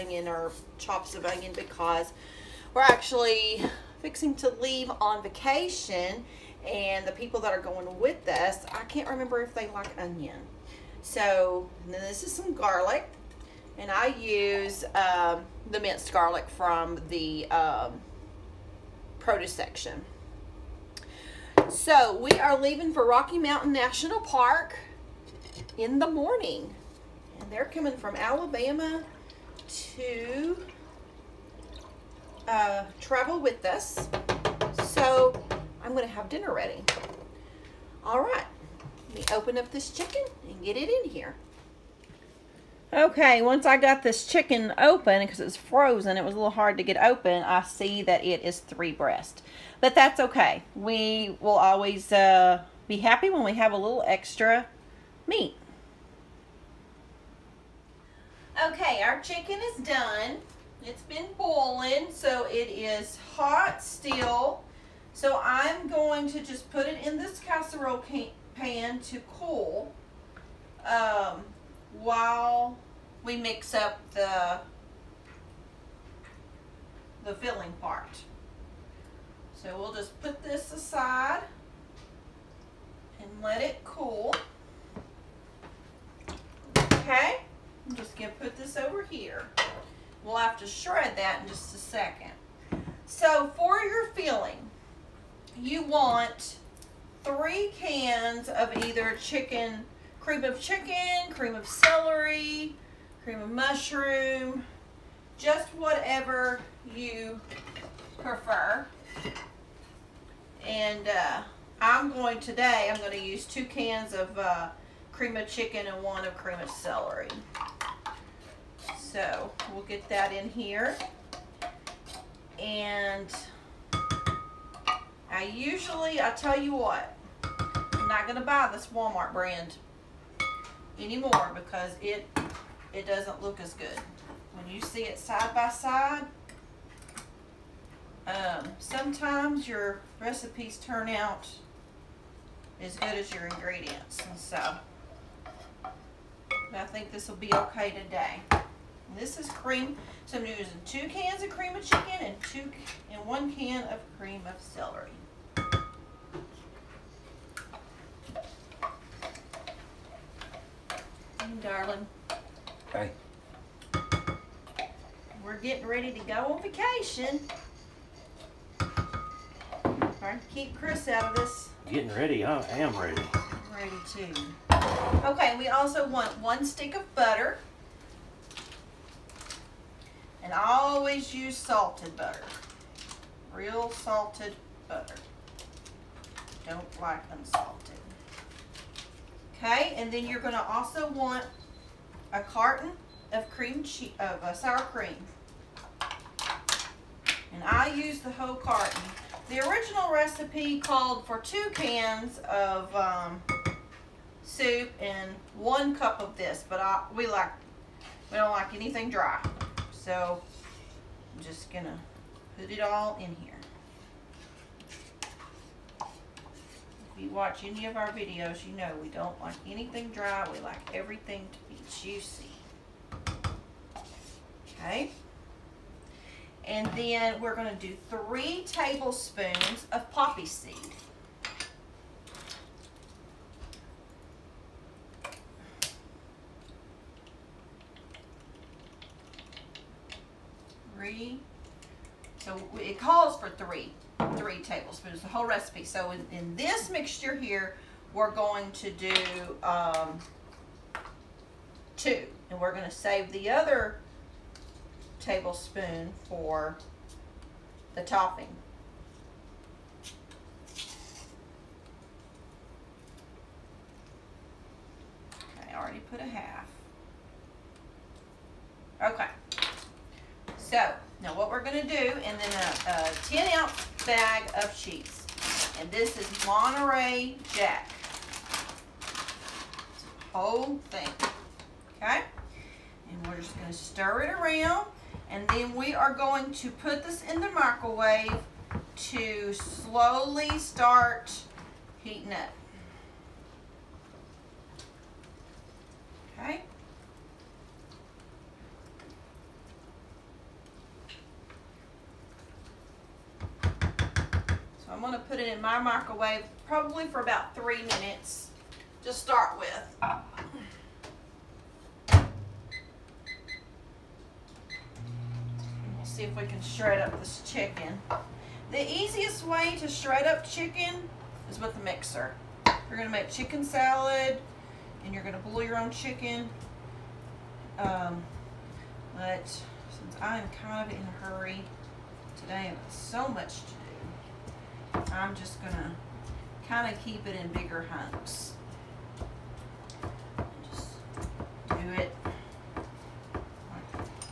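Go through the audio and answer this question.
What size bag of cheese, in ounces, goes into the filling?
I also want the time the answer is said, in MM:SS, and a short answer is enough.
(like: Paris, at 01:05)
10 ounce, at 04:33.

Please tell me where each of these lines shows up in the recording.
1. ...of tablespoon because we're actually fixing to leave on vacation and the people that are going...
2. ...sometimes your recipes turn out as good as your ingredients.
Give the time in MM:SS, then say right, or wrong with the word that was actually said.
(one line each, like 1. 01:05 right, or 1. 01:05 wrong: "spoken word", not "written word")
1. 00:01 wrong: "onion", not "tablespoon"
2. 02:18 right.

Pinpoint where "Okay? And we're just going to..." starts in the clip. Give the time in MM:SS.
04:42.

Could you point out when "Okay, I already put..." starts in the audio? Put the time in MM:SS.
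04:25.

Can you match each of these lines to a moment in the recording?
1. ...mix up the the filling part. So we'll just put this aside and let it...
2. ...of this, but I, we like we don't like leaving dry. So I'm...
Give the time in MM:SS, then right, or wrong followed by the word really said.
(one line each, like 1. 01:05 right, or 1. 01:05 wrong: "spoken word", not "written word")
1. 01:13 right
2. 03:26 wrong: "anything", not "leaving".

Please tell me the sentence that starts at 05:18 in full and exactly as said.
The easiest way to shred up chicken is with a mixer.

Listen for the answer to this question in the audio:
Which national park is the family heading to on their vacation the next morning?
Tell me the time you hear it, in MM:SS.
00:23.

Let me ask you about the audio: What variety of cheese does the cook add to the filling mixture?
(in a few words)
Monterey Jack.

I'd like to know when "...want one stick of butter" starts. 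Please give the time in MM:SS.
02:56.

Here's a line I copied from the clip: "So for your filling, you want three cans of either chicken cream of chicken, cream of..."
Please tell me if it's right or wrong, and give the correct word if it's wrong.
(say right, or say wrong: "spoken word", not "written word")
right.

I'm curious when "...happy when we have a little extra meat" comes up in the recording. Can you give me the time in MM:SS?
00:52.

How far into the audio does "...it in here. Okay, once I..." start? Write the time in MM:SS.
00:40.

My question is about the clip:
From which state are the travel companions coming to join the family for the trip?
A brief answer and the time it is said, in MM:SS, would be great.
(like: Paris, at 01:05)
Alabama, at 00:28.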